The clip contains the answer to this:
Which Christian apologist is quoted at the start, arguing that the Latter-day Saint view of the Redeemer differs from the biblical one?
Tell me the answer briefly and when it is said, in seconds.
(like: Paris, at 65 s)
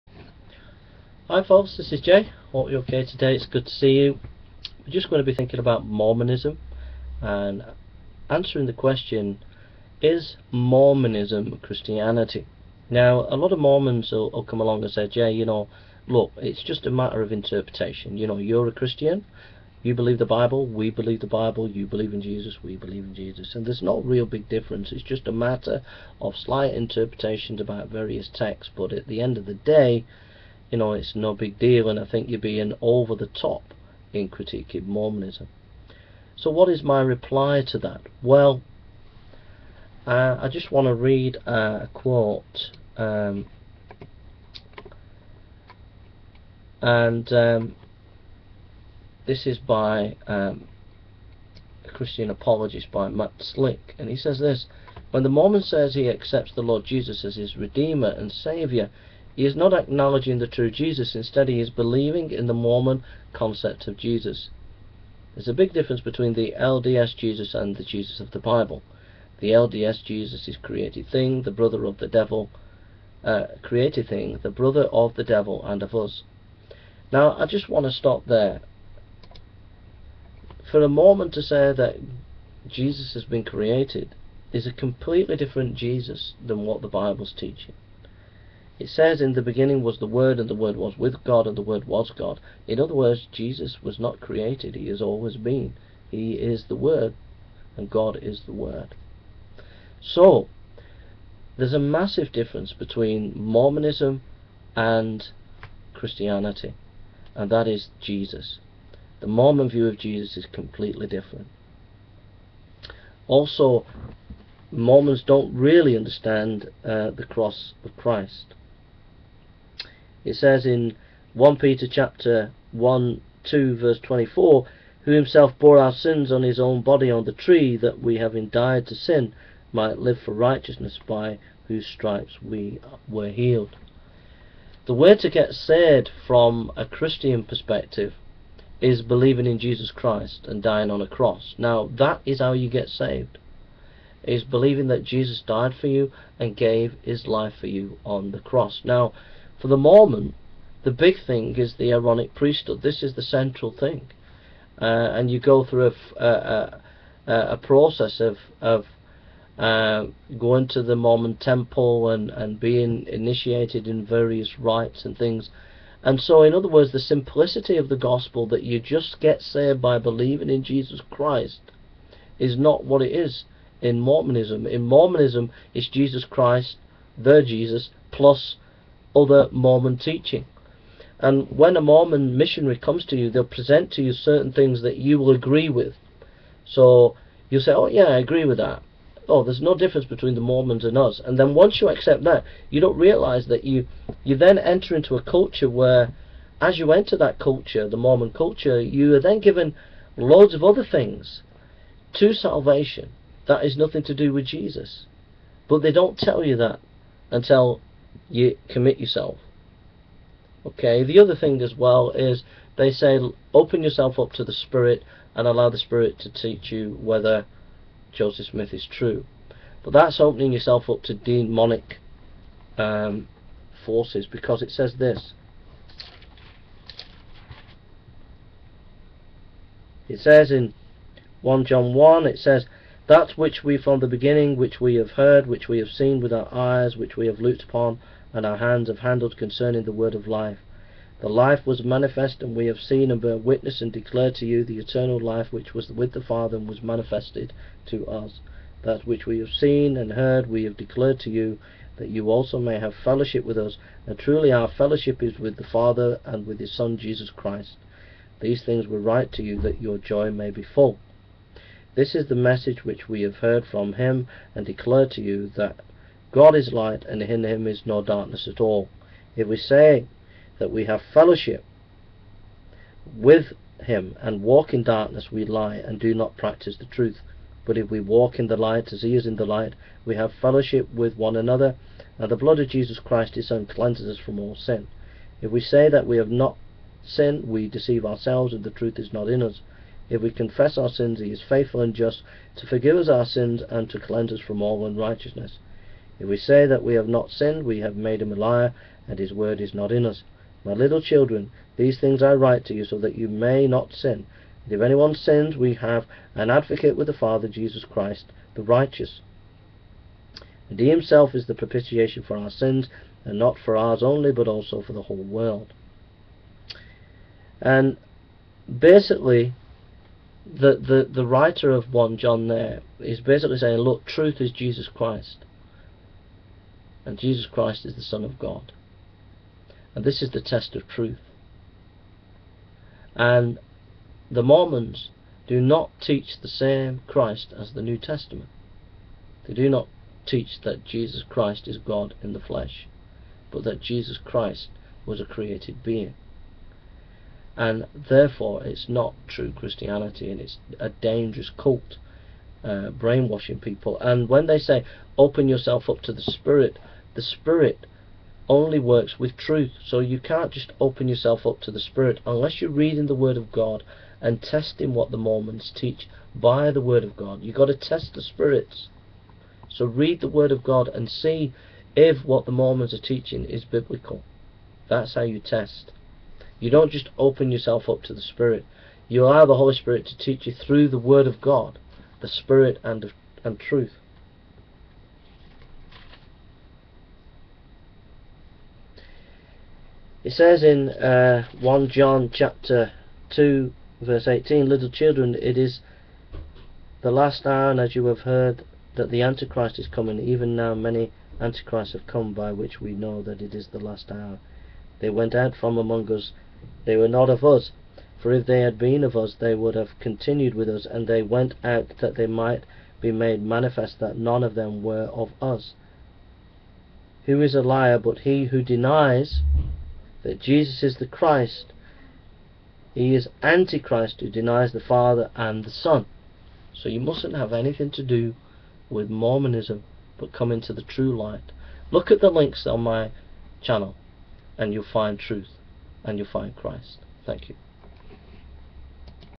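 Matt Slick, at 53 s.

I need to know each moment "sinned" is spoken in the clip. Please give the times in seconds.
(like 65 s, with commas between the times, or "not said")
287 s, 297 s.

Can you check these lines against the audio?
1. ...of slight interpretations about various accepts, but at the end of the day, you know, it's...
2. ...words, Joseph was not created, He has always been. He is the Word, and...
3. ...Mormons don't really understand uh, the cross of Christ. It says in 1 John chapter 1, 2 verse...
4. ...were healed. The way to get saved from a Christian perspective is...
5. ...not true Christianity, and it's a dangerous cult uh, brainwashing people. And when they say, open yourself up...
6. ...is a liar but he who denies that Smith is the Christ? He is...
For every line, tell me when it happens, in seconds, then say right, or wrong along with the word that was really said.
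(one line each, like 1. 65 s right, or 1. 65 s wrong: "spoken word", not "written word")
1. 26 s wrong: "texts", not "accepts"
2. 92 s wrong: "Jesus", not "Joseph"
3. 114 s wrong: "Peter", not "John"
4. 133 s right
5. 348 s right
6. 417 s wrong: "Jesus", not "Smith".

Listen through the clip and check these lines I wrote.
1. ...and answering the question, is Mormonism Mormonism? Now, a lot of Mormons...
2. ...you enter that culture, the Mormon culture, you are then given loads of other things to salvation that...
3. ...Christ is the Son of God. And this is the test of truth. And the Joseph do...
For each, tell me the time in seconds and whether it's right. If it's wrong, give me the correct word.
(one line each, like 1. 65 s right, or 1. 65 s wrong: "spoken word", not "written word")
1. 7 s wrong: "Christianity", not "Mormonism"
2. 196 s right
3. 327 s wrong: "Mormons", not "Joseph".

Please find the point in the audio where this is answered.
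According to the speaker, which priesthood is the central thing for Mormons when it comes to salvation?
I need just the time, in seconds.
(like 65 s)
151 s.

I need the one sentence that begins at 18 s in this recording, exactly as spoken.
You know, you're a Christian, you believe the Bible, we believe the Bible, you believe in Jesus, we believe in Jesus.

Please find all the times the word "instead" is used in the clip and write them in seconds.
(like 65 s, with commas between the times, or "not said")
61 s.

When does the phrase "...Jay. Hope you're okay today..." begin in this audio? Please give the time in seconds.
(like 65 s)
2 s.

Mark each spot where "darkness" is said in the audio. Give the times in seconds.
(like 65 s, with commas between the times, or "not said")
268 s, 274 s.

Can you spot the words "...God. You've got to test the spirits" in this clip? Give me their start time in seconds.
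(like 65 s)
367 s.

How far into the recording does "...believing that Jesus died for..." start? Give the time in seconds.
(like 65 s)
144 s.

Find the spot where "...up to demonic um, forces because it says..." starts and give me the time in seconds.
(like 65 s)
220 s.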